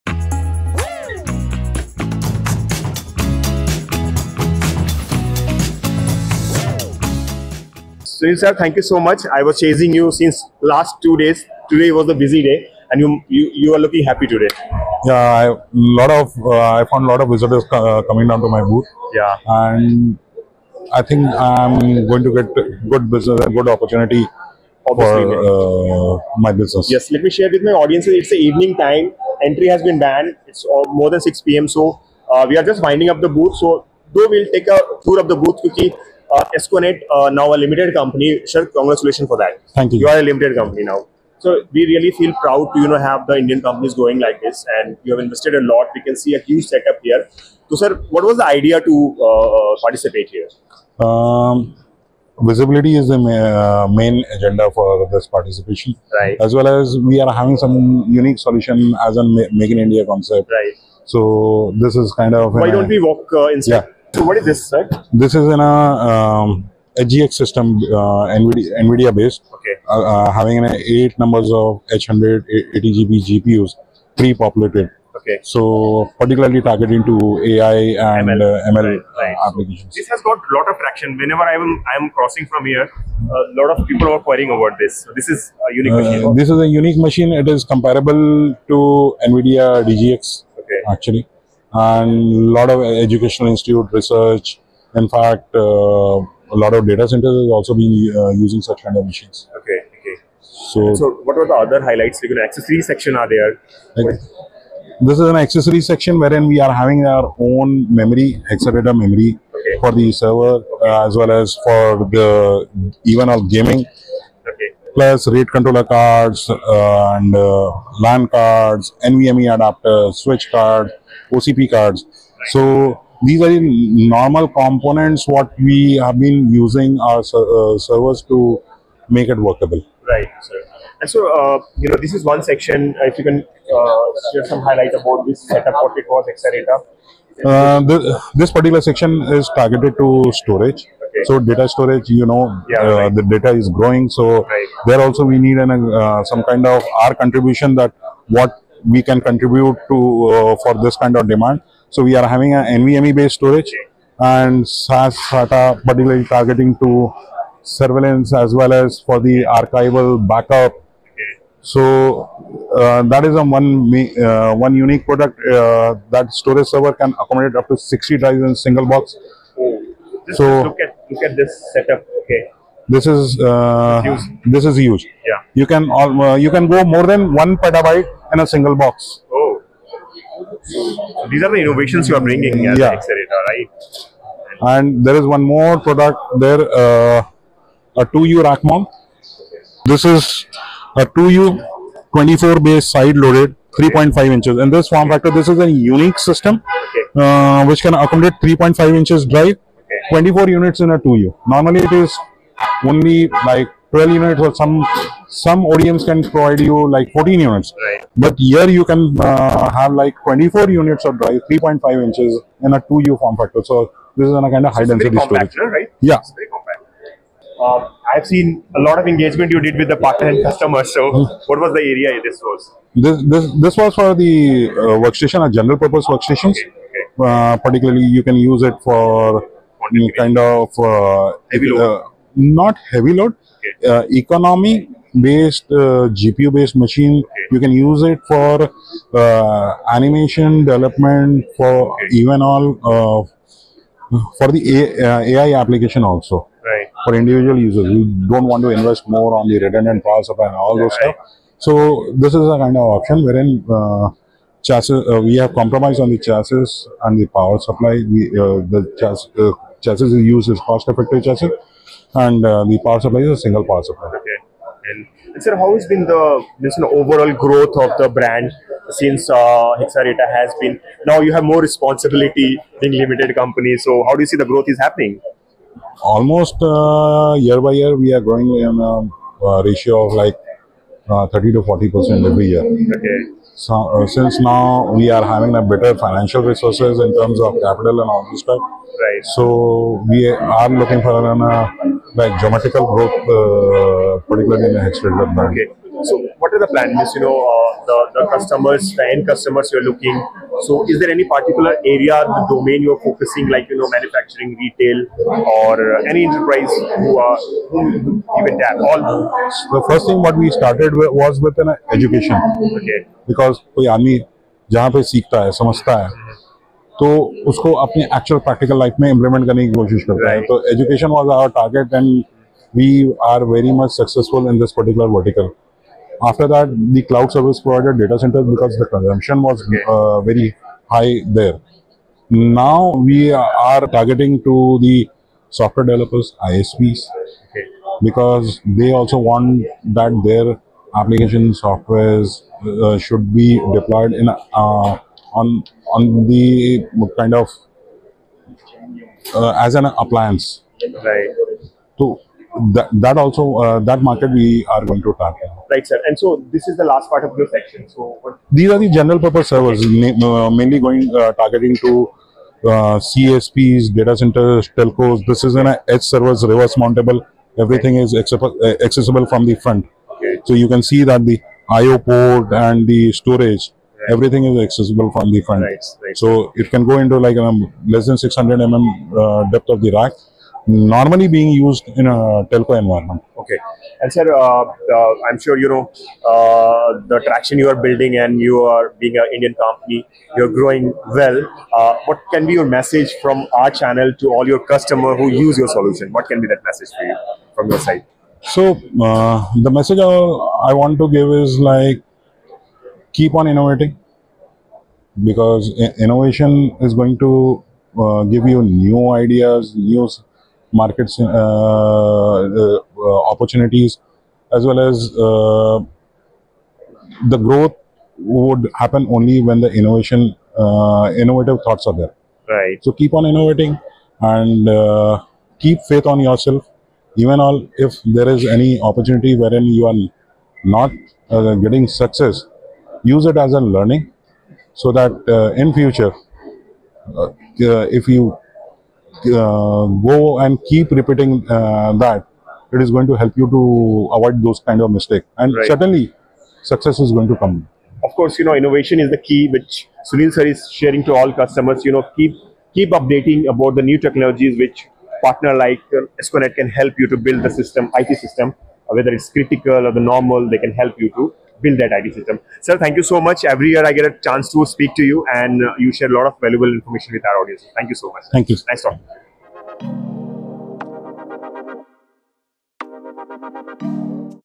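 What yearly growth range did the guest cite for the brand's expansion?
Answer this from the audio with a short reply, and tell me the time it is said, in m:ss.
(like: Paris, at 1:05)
30 to 40 percent, at 4:41.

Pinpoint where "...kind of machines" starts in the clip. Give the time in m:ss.
1:38.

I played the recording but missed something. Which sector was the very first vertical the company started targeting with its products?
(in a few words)
Education.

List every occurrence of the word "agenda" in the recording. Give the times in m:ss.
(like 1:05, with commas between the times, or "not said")
0:54.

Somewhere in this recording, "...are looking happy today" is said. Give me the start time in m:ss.
0:13.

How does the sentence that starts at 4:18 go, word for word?
We, uh, the chassis, uh, chassis is used as cost effective chassis and uh, the power supply is a single power supply.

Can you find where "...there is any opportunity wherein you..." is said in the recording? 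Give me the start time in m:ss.
7:08.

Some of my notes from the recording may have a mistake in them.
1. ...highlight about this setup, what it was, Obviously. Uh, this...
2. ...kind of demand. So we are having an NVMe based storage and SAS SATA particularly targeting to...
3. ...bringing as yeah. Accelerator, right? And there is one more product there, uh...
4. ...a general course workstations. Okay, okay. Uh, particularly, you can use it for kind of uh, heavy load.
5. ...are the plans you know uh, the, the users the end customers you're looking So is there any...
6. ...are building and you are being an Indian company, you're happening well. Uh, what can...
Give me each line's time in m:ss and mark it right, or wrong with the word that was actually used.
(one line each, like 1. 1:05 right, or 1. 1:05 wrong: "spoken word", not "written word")
1. 2:14 wrong: "Accelerator", not "Obviously"
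2. 2:30 right
3. 3:02 right
4. 3:45 wrong: "purpose", not "course"
5. 4:56 wrong: "customers", not "users"
6. 6:27 wrong: "growing", not "happening".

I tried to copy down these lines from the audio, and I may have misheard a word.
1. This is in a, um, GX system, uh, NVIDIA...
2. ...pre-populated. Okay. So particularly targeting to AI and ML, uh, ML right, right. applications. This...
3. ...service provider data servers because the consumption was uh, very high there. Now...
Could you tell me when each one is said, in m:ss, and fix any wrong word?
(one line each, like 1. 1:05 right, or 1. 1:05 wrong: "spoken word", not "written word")
1. 1:05 right
2. 1:14 right
3. 5:27 wrong: "centers", not "servers".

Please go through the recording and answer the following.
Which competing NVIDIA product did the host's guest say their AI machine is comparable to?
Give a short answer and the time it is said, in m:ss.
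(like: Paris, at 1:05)
NVIDIA DGX, at 1:29.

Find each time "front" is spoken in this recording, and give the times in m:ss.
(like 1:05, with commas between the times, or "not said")
6:09, 6:15.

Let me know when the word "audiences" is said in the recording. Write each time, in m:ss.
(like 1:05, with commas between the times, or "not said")
0:27, 7:47.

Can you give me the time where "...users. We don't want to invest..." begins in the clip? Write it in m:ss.
4:07.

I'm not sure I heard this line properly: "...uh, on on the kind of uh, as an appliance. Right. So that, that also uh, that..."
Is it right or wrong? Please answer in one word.
right.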